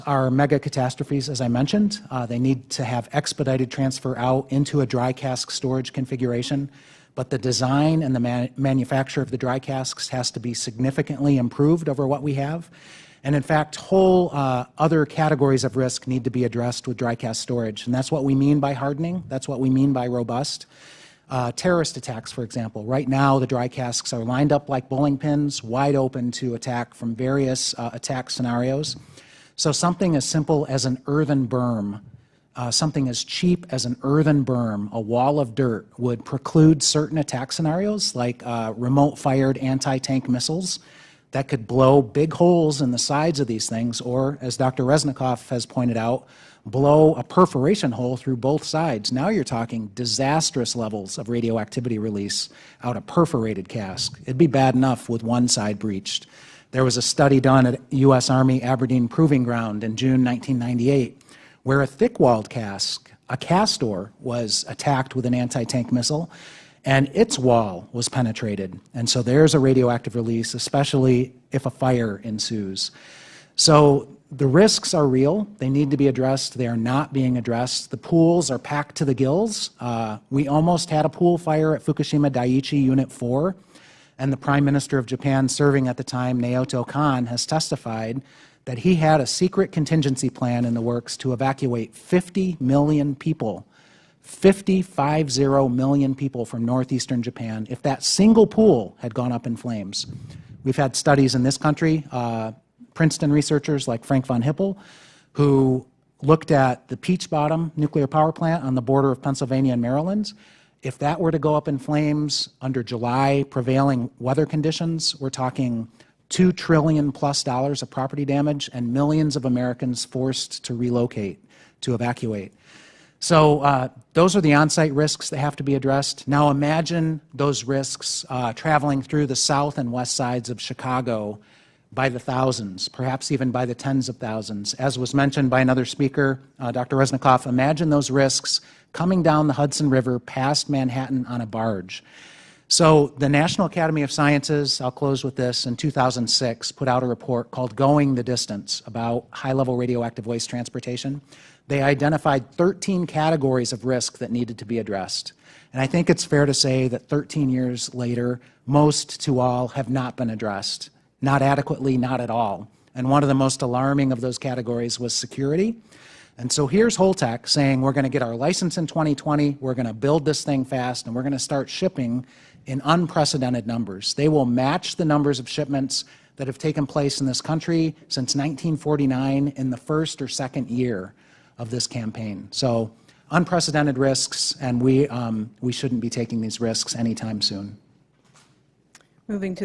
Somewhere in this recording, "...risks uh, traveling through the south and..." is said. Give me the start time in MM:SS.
02:07.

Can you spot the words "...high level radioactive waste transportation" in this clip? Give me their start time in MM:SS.
02:29.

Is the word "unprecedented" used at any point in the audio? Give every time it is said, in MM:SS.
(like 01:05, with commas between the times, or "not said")
02:52, 03:03.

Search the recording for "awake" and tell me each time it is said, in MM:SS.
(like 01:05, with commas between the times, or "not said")
not said.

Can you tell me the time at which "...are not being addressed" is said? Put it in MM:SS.
01:16.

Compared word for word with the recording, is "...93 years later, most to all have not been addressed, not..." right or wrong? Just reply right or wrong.
wrong.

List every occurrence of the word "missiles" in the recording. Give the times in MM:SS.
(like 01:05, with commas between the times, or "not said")
00:40, 01:05.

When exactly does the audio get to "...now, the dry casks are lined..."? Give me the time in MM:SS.
00:23.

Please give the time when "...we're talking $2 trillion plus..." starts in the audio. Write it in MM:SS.
01:55.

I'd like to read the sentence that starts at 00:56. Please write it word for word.
There was a study done at U.S.